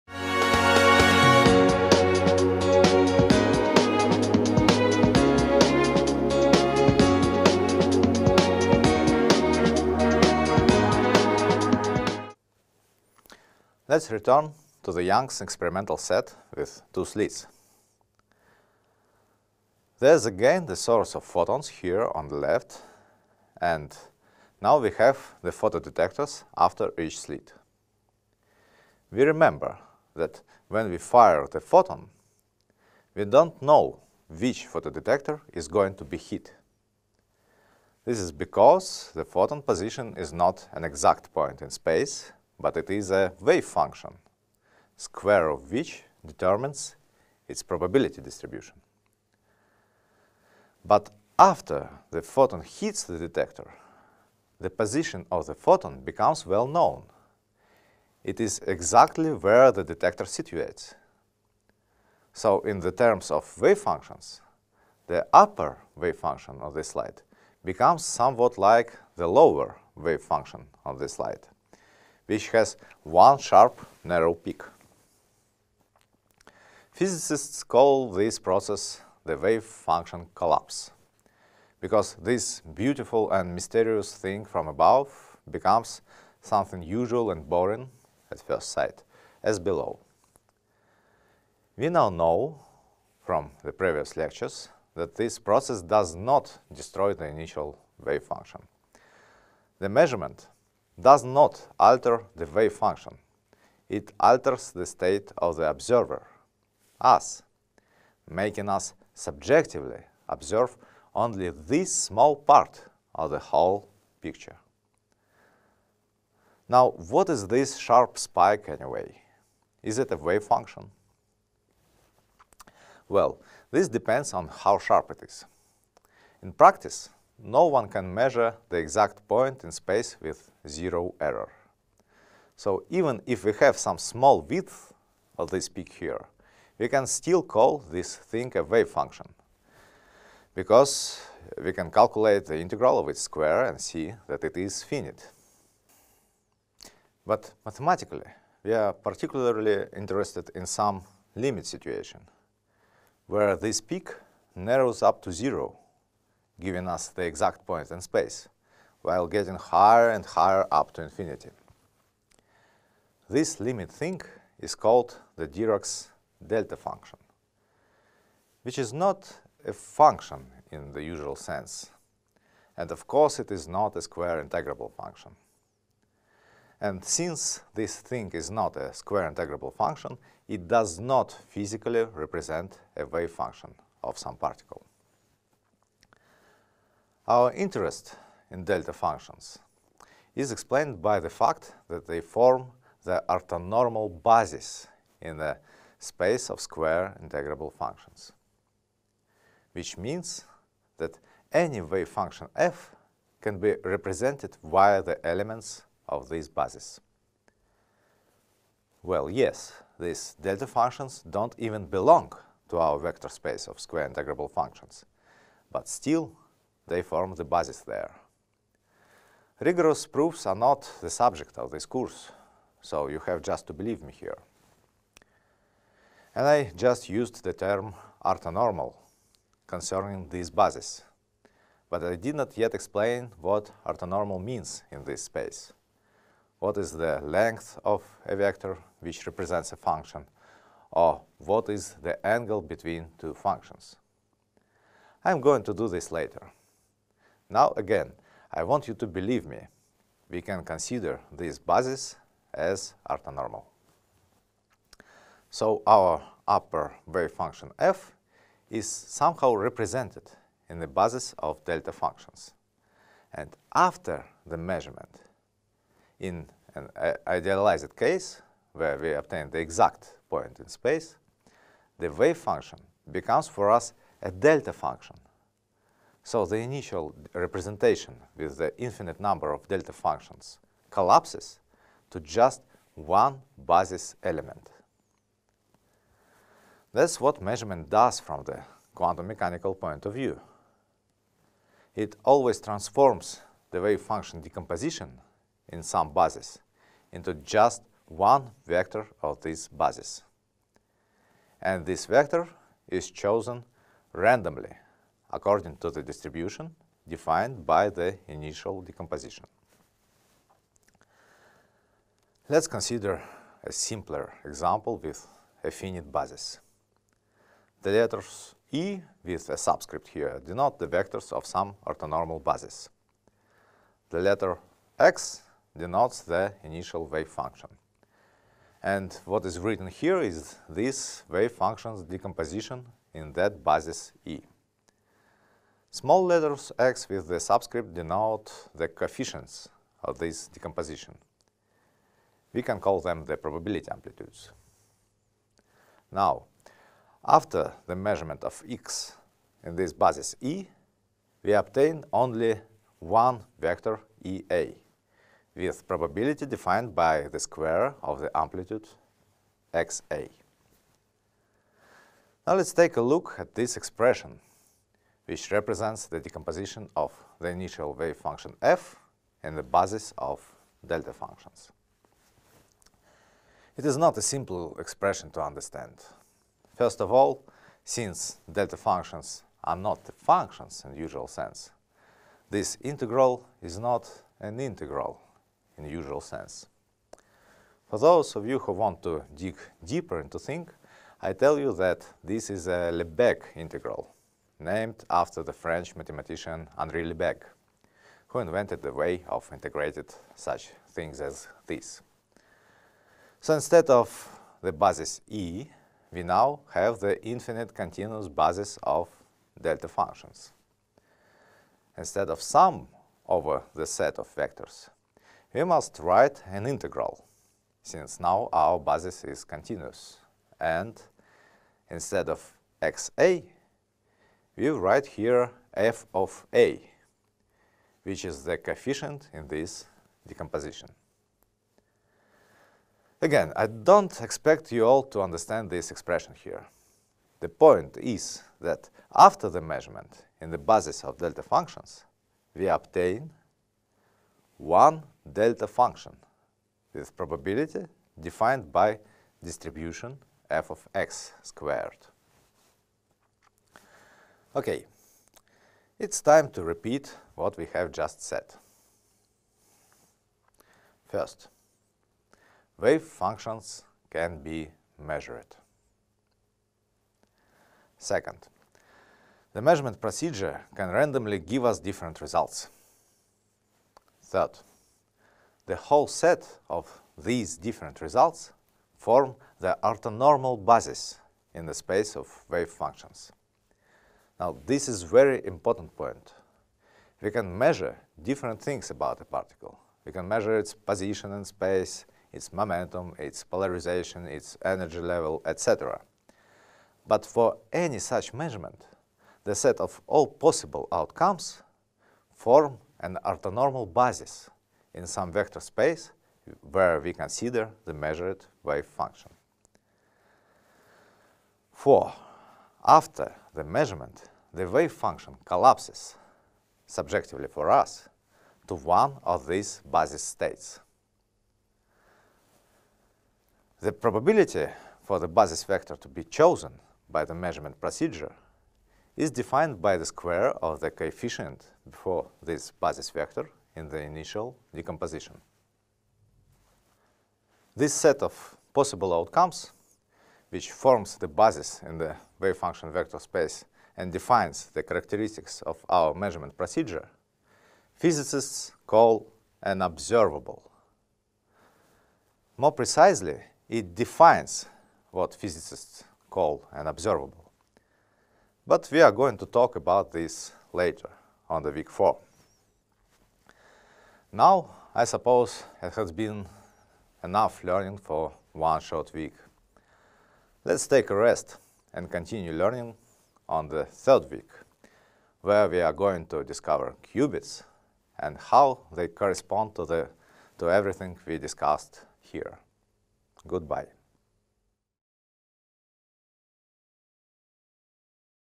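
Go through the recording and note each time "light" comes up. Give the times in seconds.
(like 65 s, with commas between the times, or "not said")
66 s, 71 s.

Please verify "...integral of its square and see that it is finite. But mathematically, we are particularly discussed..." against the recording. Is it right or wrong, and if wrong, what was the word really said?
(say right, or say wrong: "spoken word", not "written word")
wrong: "interested", not "discussed".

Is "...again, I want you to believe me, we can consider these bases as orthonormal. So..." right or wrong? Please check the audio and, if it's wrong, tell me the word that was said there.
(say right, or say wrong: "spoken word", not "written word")
right.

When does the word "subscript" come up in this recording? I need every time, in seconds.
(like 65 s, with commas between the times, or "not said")
319 s, 337 s.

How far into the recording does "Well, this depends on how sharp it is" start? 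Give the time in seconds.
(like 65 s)
123 s.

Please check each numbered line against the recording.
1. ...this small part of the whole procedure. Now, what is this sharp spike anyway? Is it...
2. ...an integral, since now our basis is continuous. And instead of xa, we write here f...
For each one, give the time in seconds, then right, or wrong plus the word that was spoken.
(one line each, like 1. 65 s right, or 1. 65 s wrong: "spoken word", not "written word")
1. 111 s wrong: "picture", not "procedure"
2. 416 s right.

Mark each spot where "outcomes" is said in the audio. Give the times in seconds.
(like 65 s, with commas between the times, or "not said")
500 s, 539 s.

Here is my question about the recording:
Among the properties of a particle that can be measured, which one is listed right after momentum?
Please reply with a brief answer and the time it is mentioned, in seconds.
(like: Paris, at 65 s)
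polarization, at 493 s.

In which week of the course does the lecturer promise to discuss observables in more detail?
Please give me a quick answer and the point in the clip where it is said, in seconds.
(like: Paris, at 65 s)
week 4, at 561 s.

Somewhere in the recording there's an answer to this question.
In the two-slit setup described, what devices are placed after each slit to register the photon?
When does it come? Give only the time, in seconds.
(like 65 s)
25 s.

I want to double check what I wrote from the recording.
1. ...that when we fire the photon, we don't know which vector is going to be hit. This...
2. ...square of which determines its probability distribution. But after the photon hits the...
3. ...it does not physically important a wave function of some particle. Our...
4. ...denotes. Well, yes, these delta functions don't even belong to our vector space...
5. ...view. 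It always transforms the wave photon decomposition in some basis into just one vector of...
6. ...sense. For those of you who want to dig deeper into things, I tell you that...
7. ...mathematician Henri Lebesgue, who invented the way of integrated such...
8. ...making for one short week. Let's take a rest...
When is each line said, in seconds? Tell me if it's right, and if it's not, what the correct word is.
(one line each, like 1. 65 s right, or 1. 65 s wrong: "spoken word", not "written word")
1. 30 s wrong: "photodetector", not "vector"
2. 44 s right
3. 180 s wrong: "represent", not "important"
4. 206 s wrong: "bases", not "denotes"
5. 290 s wrong: "function", not "photon"
6. 386 s right
7. 395 s right
8. 567 s wrong: "learning", not "making".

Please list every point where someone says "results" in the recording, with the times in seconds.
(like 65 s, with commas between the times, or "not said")
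472 s, 478 s.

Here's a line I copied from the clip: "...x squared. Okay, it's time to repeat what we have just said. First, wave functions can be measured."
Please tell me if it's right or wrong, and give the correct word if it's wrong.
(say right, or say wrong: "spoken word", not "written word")
right.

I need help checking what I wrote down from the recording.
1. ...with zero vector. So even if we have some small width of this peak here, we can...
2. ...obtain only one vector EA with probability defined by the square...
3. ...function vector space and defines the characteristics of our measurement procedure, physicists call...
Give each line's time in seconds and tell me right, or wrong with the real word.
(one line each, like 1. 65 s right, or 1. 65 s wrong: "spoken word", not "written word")
1. 130 s wrong: "error", not "vector"
2. 351 s right
3. 542 s right.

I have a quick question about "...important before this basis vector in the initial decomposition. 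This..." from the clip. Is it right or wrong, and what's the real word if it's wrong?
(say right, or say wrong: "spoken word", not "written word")
wrong: "coefficient", not "important".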